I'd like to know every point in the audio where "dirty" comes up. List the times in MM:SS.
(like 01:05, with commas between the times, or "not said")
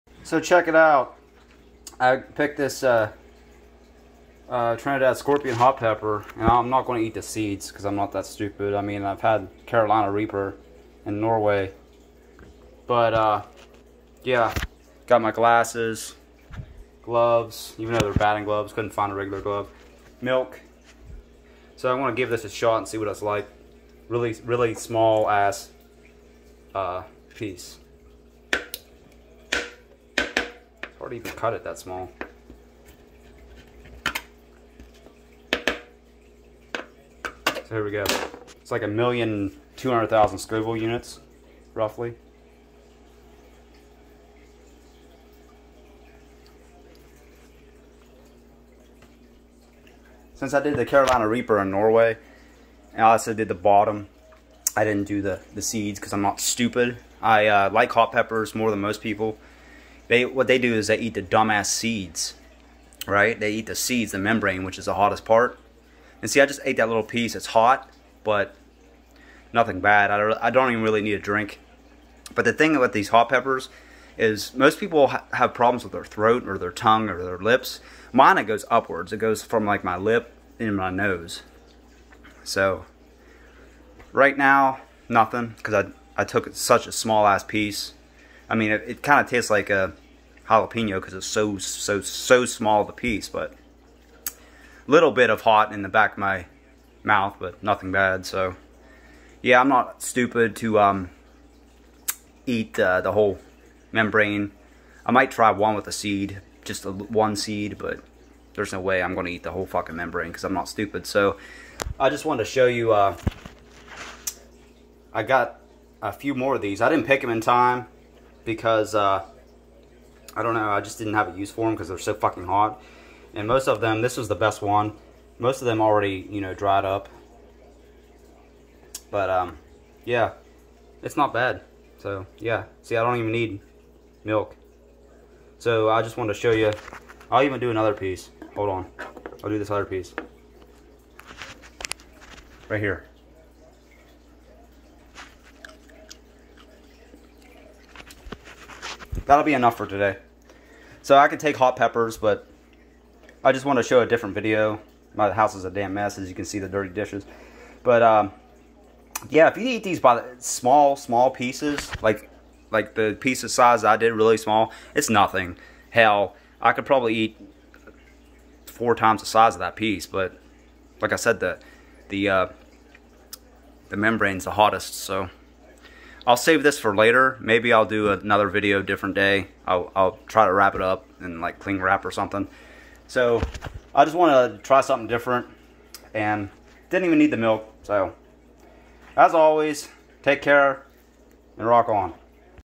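02:36.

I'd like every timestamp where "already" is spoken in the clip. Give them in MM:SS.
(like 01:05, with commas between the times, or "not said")
00:31, 02:05.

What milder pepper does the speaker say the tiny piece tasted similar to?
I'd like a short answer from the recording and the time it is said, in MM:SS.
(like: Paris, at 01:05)
Jalapeno, at 01:30.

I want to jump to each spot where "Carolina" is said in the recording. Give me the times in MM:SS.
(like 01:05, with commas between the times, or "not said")
00:09, 00:50.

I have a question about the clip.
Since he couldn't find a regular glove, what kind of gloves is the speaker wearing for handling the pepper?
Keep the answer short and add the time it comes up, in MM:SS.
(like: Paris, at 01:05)
Batting gloves, at 00:18.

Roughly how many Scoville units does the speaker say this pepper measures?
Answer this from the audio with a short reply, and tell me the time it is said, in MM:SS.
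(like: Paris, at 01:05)
1,200,000, at 00:38.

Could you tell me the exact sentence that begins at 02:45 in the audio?
Hell, I could probably eat four times the size of that piece.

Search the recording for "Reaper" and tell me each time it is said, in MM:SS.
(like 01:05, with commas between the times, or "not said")
00:10, 00:51.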